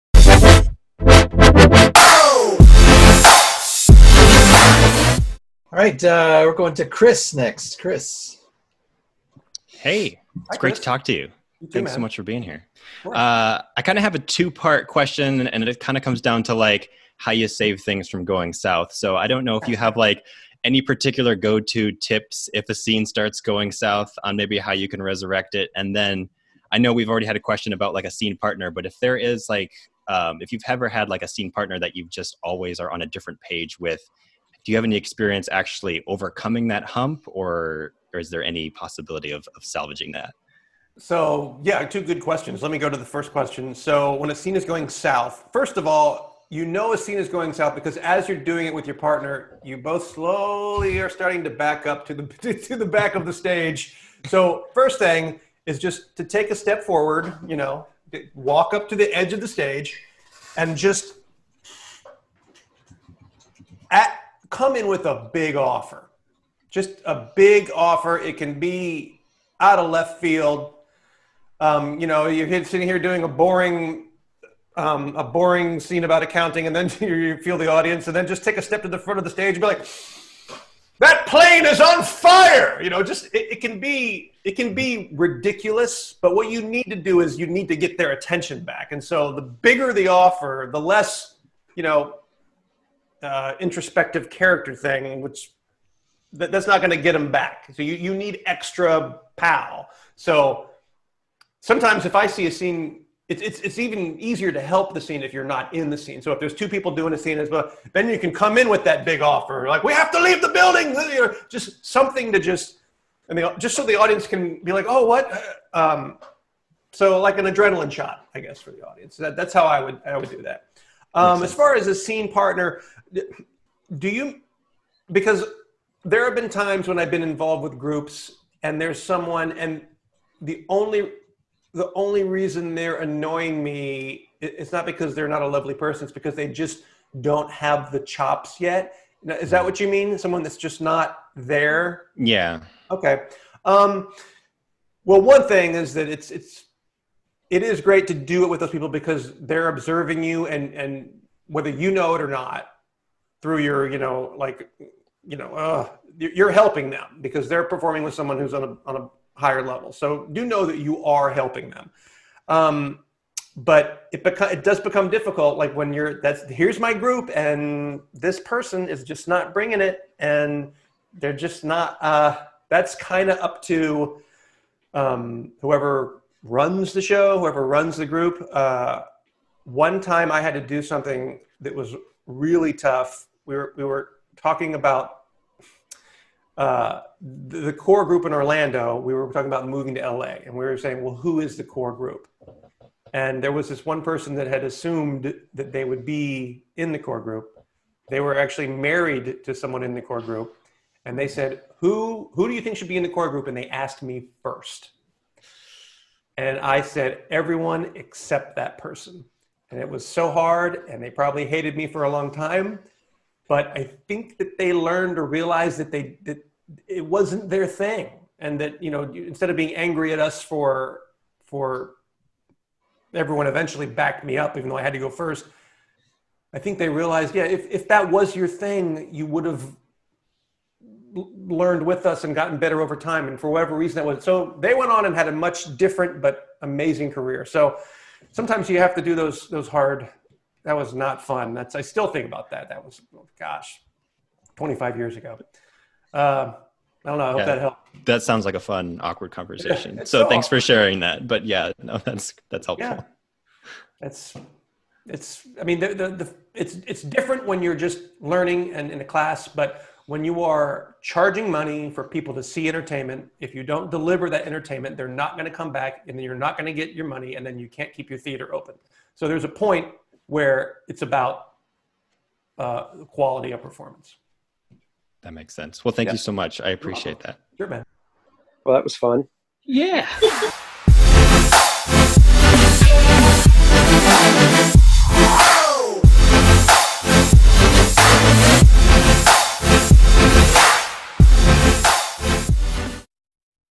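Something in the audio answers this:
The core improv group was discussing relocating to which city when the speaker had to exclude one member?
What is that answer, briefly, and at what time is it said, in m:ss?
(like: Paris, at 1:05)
LA, at 3:10.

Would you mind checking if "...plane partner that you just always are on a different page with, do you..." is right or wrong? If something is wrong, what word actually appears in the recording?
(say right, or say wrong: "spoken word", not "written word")
wrong: "scene", not "plane".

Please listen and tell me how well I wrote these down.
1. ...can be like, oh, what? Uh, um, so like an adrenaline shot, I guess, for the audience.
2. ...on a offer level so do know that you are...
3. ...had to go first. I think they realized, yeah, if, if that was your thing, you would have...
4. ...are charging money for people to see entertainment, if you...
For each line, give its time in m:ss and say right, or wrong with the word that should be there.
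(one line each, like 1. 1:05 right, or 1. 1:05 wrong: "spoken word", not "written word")
1. 1:54 right
2. 2:38 wrong: "higher", not "offer"
3. 3:44 right
4. 4:20 right.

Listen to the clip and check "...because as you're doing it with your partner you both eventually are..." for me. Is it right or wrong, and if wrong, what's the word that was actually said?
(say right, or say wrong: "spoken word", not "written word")
wrong: "slowly", not "eventually".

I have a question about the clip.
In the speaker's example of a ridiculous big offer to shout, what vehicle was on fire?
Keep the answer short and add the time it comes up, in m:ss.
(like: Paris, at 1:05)
plane, at 1:21.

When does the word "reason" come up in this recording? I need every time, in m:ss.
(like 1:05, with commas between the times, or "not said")
2:12, 3:53.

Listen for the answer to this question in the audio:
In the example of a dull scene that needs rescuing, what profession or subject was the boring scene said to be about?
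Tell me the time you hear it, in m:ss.
1:16.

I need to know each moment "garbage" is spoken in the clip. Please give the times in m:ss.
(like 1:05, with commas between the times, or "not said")
not said.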